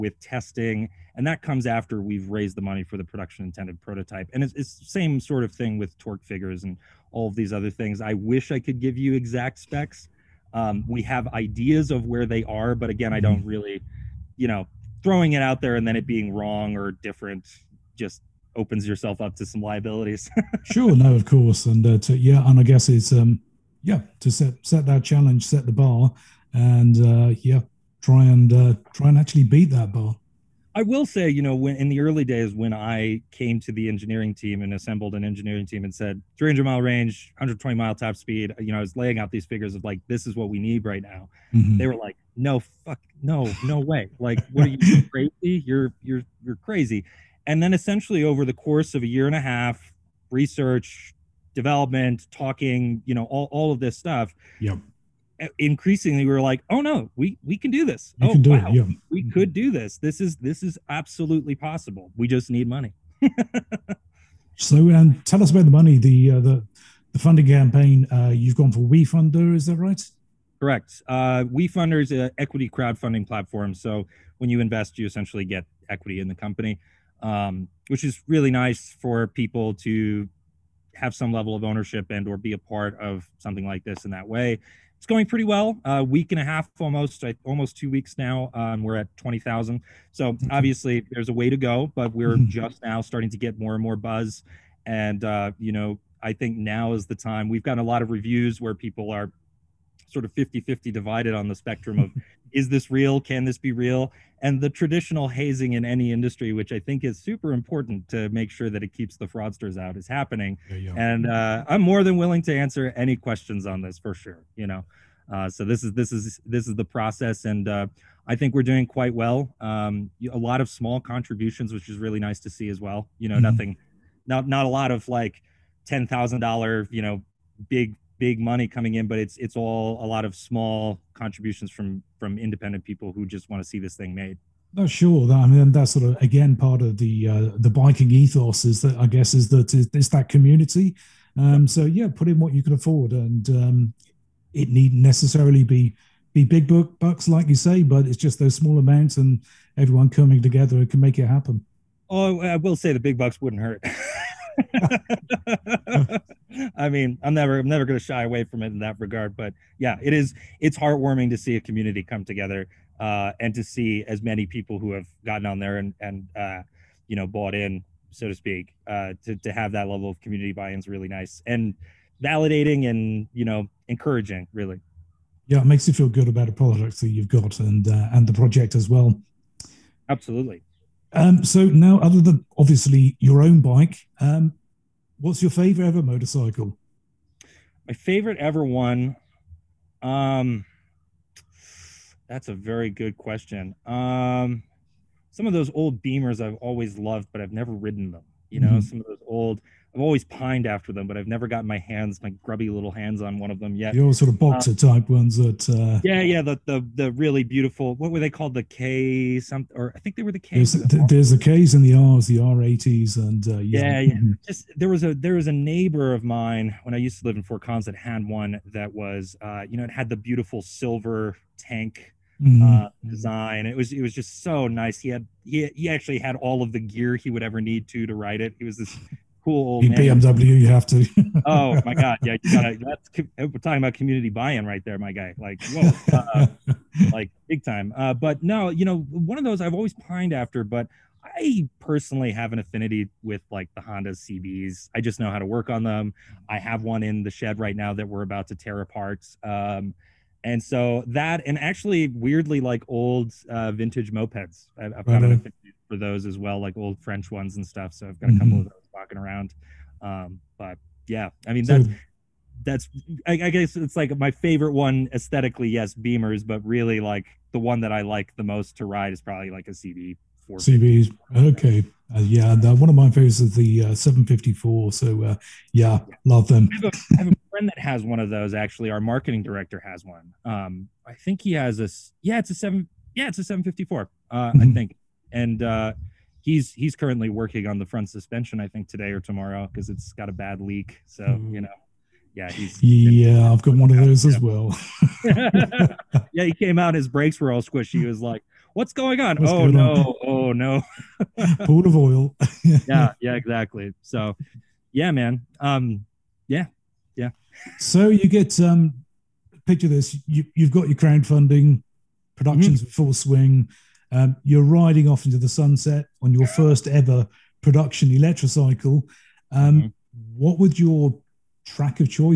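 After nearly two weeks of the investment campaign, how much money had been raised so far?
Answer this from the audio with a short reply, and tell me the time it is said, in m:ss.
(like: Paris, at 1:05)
20,000, at 1:29.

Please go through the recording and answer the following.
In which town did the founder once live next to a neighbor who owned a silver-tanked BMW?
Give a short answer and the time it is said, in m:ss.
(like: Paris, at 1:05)
Fort Collins, at 3:37.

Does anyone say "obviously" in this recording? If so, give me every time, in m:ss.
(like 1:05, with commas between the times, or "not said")
1:30, 3:02.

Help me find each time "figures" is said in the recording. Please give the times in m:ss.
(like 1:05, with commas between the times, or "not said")
0:06, 0:39.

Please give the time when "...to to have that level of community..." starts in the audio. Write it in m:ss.
2:49.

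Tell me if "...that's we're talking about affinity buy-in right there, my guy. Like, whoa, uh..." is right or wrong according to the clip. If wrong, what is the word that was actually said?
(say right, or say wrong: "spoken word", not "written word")
wrong: "community", not "affinity".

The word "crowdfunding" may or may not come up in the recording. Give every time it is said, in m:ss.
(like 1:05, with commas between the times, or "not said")
1:12, 5:10.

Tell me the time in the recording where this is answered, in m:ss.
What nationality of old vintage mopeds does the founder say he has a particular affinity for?
4:17.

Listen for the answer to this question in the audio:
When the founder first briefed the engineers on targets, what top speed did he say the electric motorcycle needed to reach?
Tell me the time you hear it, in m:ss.
0:37.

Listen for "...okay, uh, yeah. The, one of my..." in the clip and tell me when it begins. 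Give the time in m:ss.
4:31.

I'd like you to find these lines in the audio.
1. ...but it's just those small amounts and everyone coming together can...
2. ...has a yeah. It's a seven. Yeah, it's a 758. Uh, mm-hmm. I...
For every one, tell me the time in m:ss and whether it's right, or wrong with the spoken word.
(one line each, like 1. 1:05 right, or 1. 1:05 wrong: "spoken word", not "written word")
1. 2:27 right
2. 4:41 wrong: "754", not "758".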